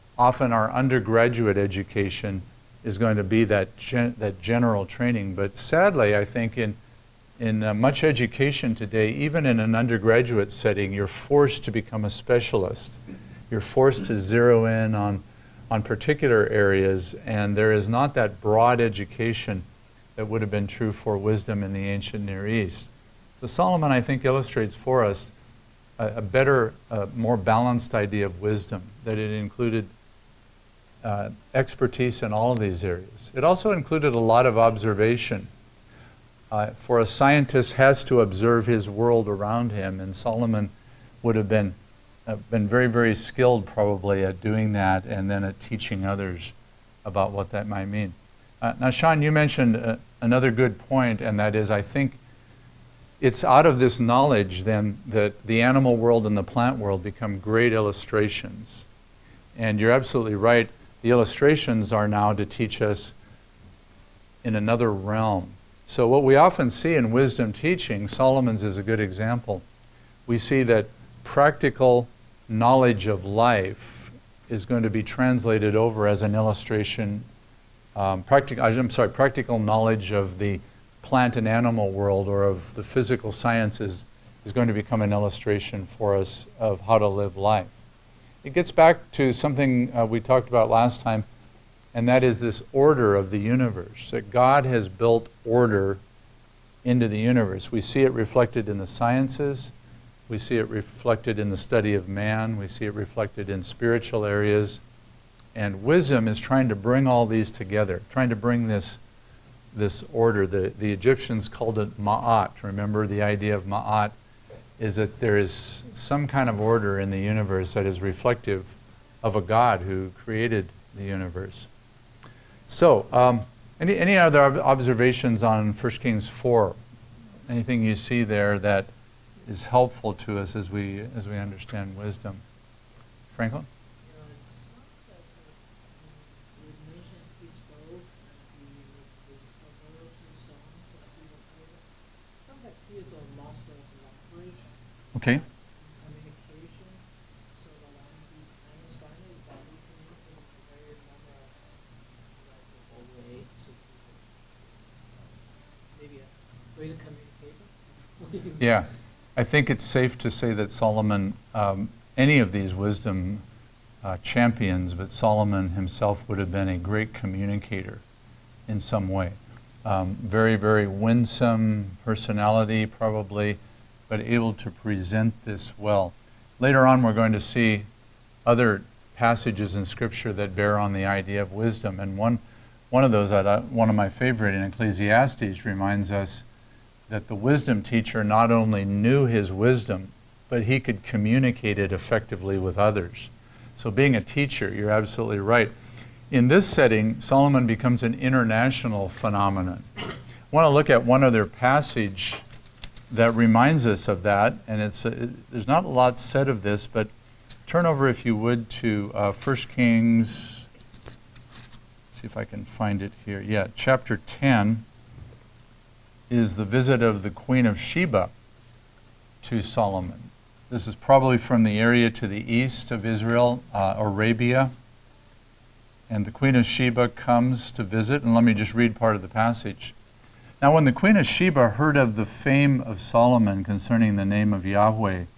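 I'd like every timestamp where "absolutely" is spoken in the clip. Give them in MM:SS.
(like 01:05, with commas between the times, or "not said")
00:59, 03:14.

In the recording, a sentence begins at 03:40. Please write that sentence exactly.
This is probably from the area to the east of Israel, uh, Arabia.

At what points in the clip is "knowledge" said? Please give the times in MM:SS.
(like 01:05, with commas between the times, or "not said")
00:53, 01:12, 01:19.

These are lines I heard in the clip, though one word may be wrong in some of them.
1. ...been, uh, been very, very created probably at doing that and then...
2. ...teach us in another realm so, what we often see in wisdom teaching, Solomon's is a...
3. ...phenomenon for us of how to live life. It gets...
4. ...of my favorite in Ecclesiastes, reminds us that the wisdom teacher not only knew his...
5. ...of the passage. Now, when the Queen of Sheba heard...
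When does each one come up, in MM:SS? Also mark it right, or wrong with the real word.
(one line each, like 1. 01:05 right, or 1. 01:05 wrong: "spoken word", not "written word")
1. 00:41 wrong: "skilled", not "created"
2. 01:02 right
3. 01:25 wrong: "illustration", not "phenomenon"
4. 03:03 right
5. 03:49 right.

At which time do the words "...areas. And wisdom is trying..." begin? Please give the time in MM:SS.
01:44.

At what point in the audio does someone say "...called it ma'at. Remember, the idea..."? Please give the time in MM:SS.
01:51.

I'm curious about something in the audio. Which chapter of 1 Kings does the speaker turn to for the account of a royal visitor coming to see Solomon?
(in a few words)
Chapter 10.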